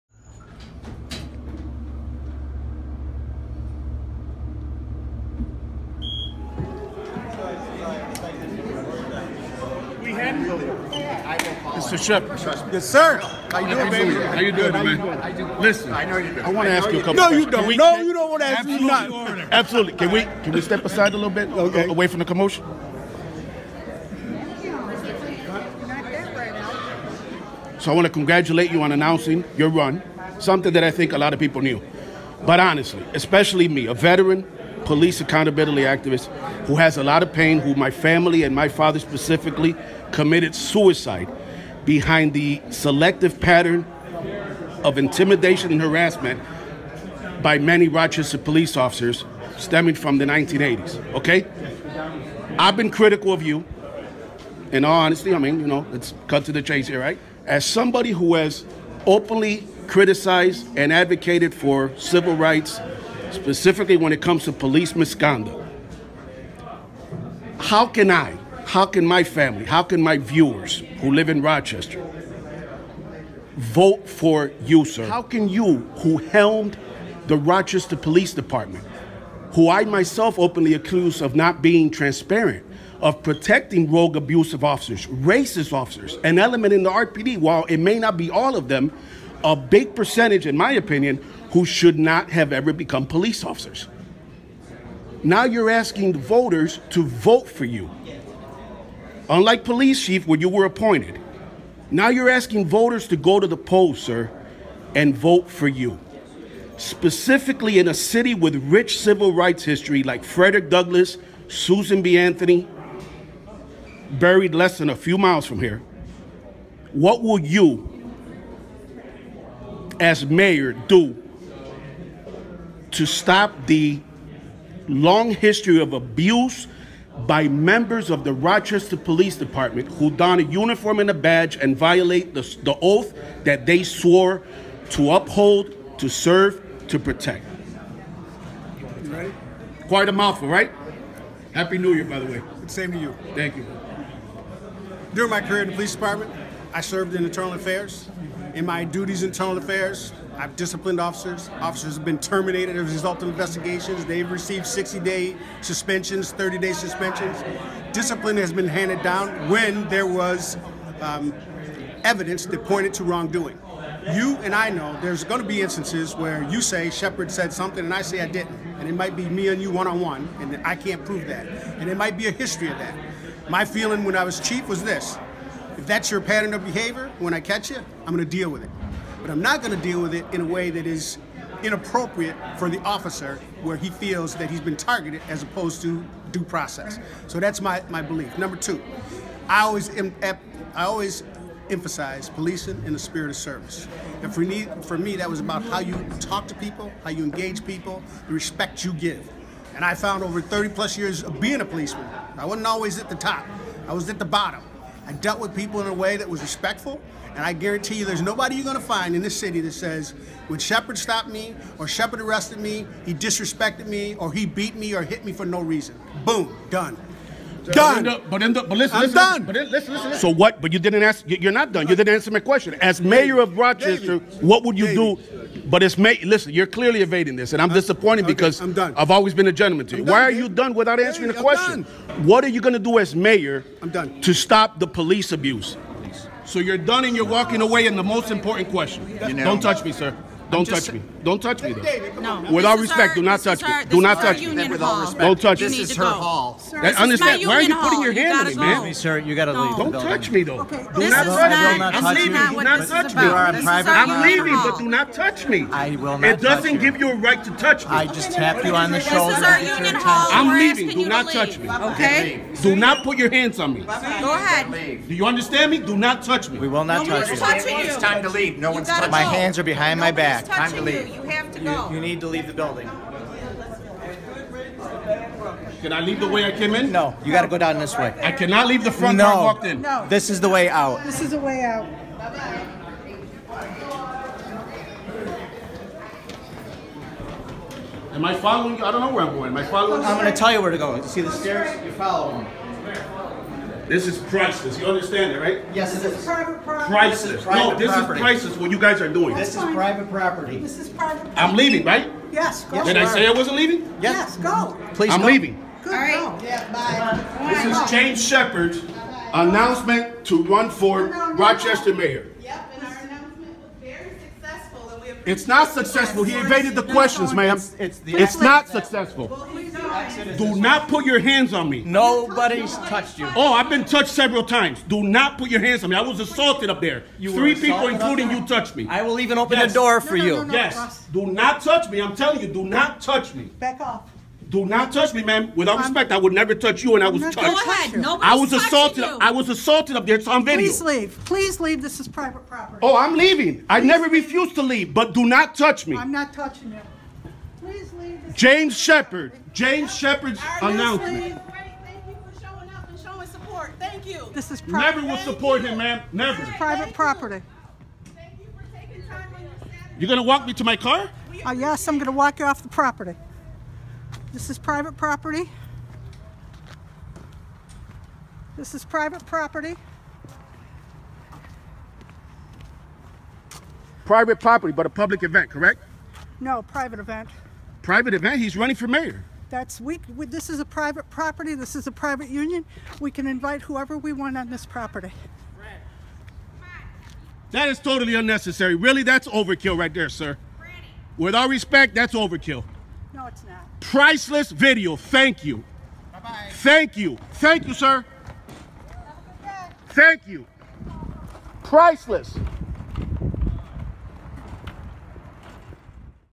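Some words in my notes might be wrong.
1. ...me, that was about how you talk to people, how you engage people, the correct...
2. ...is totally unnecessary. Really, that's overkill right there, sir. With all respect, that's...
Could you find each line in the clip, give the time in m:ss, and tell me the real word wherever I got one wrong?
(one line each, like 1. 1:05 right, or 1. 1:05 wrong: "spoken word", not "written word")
1. 3:14 wrong: "respect", not "correct"
2. 6:27 right.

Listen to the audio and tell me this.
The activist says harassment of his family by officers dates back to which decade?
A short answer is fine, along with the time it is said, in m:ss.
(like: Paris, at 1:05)
1980s, at 0:50.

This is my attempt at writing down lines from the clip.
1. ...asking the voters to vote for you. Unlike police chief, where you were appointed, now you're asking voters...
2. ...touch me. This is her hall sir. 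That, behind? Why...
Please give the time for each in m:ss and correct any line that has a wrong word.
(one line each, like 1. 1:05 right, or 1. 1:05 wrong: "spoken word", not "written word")
1. 1:35 right
2. 4:05 wrong: "understand", not "behind".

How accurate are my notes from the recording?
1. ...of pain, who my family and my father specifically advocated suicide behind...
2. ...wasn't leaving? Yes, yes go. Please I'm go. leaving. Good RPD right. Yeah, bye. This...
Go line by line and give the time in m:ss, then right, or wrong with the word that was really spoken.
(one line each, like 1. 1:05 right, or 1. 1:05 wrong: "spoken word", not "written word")
1. 0:37 wrong: "committed", not "advocated"
2. 5:03 wrong: "All", not "RPD".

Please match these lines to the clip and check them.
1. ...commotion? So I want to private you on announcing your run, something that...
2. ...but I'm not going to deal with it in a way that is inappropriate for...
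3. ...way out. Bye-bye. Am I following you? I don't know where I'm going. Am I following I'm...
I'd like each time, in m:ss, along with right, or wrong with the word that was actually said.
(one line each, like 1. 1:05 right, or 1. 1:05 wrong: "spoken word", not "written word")
1. 0:22 wrong: "congratulate", not "private"
2. 2:59 right
3. 4:41 right.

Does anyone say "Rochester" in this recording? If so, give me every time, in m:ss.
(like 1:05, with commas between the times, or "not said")
0:47, 1:11, 1:17, 2:08, 3:43, 5:11.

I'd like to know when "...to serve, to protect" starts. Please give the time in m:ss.
2:15.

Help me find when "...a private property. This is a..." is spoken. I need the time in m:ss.
6:20.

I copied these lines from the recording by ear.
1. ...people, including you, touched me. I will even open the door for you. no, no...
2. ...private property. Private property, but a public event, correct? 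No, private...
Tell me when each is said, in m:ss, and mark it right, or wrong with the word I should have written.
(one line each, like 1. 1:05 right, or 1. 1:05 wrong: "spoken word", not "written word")
1. 5:27 right
2. 6:08 right.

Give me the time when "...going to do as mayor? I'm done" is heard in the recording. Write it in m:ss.
3:52.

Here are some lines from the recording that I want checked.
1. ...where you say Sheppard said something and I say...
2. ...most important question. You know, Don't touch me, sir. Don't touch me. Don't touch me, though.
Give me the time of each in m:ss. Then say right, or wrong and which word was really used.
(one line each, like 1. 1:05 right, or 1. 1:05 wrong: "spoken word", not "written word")
1. 2:46 right
2. 3:58 right.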